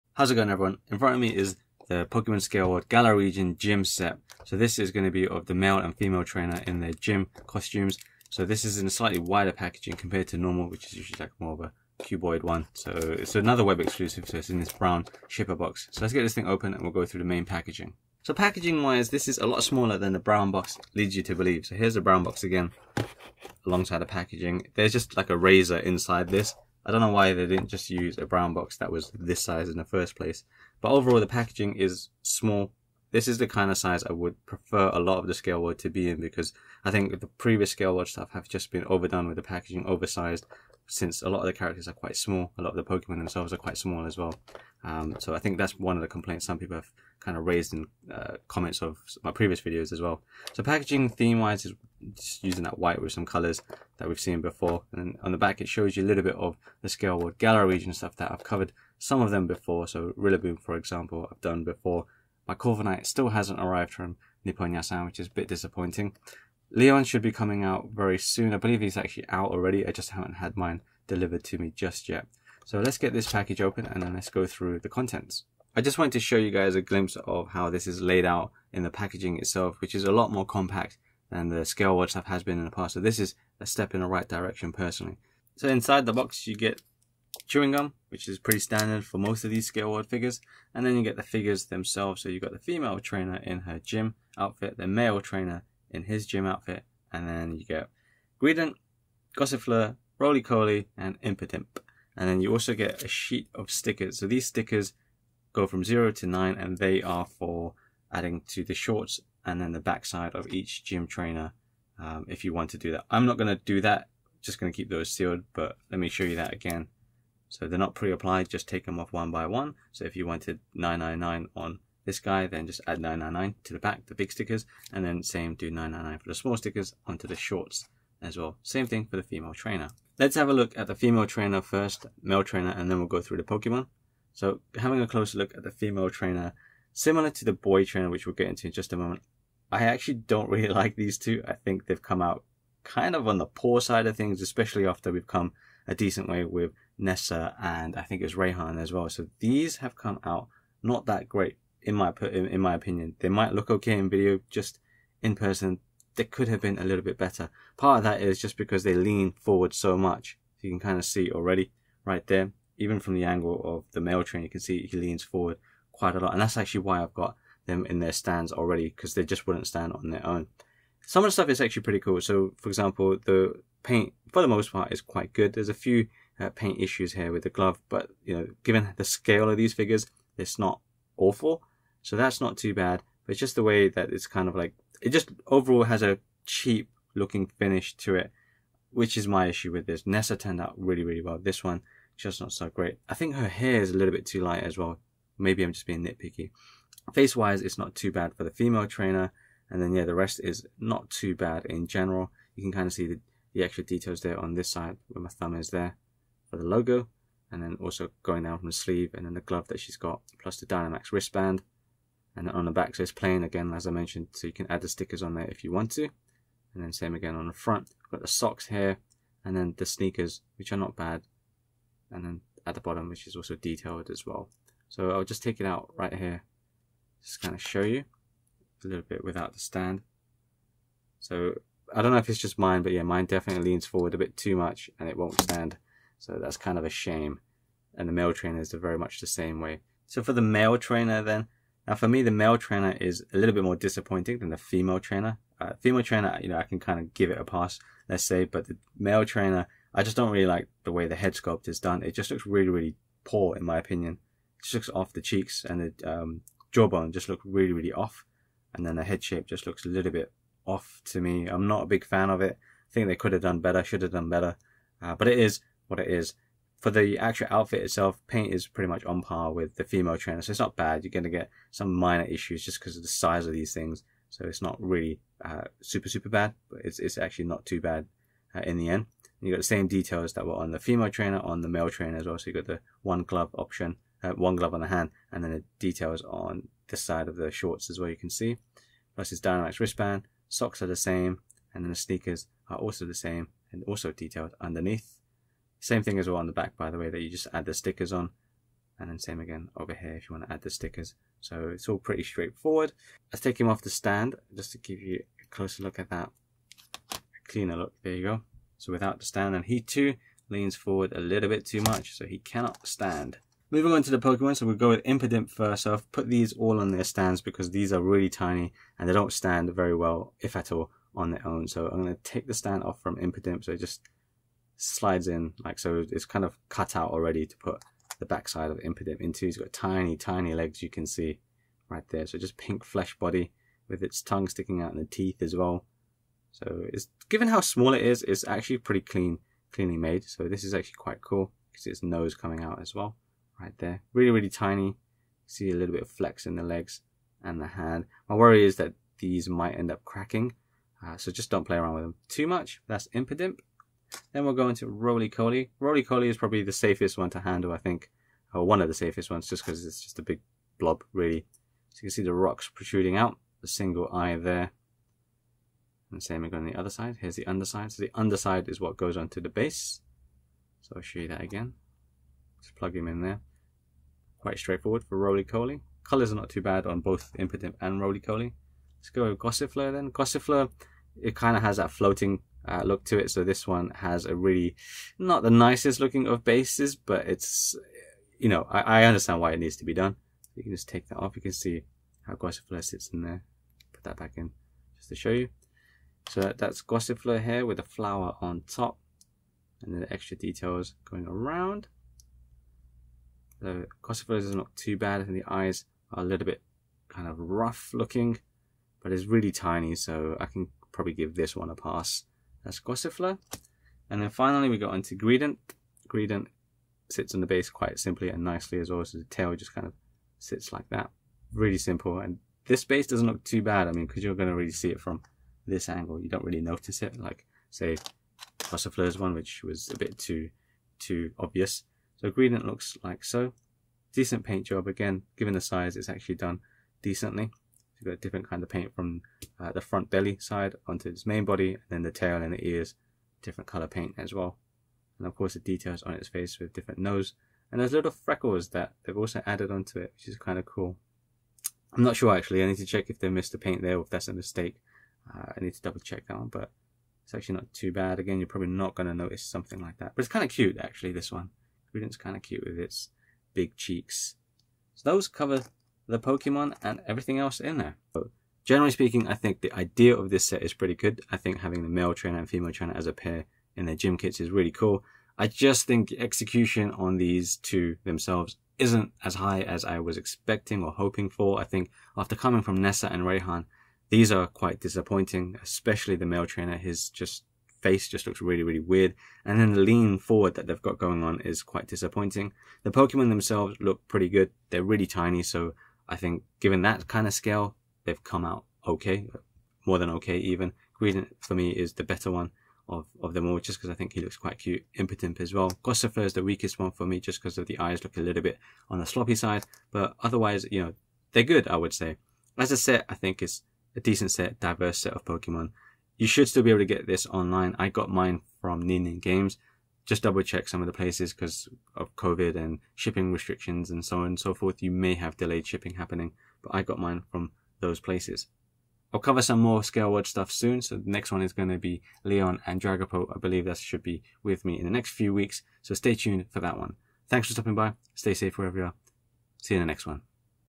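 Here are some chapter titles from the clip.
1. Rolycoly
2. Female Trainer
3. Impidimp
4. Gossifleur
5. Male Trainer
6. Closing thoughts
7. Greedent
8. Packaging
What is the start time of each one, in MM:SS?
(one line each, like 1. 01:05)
1. 05:56
2. 02:15
3. 05:15
4. 06:20
5. 04:00
6. 07:50
7. 06:55
8. 00:20.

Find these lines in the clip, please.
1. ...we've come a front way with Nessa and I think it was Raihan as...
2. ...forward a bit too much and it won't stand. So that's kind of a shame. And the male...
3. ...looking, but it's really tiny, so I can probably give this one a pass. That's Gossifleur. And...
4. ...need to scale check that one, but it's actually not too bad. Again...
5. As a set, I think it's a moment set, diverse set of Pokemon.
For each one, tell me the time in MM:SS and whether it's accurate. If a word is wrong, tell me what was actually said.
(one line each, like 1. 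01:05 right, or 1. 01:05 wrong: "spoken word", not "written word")
1. 02:25 wrong: "decent", not "front"
2. 03:53 right
3. 06:47 right
4. 07:35 wrong: "double", not "scale"
5. 08:32 wrong: "decent", not "moment".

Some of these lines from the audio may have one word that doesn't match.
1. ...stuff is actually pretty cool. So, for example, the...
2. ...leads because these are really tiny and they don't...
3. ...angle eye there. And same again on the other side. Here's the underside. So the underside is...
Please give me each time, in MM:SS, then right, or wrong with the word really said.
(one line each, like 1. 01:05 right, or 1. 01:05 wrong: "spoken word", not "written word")
1. 02:51 right
2. 05:17 wrong: "stands", not "leads"
3. 06:03 wrong: "single", not "angle".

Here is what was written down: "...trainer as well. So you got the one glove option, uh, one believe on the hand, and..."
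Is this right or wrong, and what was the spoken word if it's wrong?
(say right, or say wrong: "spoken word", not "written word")
wrong: "glove", not "believe".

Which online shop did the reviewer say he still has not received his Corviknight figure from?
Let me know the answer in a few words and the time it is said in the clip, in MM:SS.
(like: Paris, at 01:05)
Nippon Yasan, at 01:04.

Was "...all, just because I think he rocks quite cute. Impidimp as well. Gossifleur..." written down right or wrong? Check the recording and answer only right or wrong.
wrong.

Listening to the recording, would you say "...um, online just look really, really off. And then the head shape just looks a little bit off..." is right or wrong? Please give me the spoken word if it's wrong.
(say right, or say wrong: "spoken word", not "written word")
wrong: "jawbone", not "online".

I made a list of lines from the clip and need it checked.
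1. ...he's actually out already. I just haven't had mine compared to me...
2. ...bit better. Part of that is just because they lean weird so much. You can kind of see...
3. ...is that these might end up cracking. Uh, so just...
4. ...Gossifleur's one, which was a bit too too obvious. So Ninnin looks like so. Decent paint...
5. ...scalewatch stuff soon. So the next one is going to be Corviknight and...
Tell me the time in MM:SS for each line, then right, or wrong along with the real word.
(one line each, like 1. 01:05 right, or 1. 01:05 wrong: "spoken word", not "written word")
1. 01:08 wrong: "delivered", not "compared"
2. 02:37 wrong: "forward", not "weird"
3. 05:48 right
4. 07:08 wrong: "Greedent", not "Ninnin"
5. 08:49 wrong: "Leon", not "Corviknight".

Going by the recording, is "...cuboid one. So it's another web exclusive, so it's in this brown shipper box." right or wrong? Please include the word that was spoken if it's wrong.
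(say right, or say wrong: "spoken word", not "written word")
right.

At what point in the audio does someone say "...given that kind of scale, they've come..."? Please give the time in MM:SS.
08:16.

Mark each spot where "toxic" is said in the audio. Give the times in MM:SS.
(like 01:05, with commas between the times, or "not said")
not said.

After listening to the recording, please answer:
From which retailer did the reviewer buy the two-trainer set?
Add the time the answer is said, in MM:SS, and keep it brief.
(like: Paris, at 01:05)
Nin-nin Games, at 08:38.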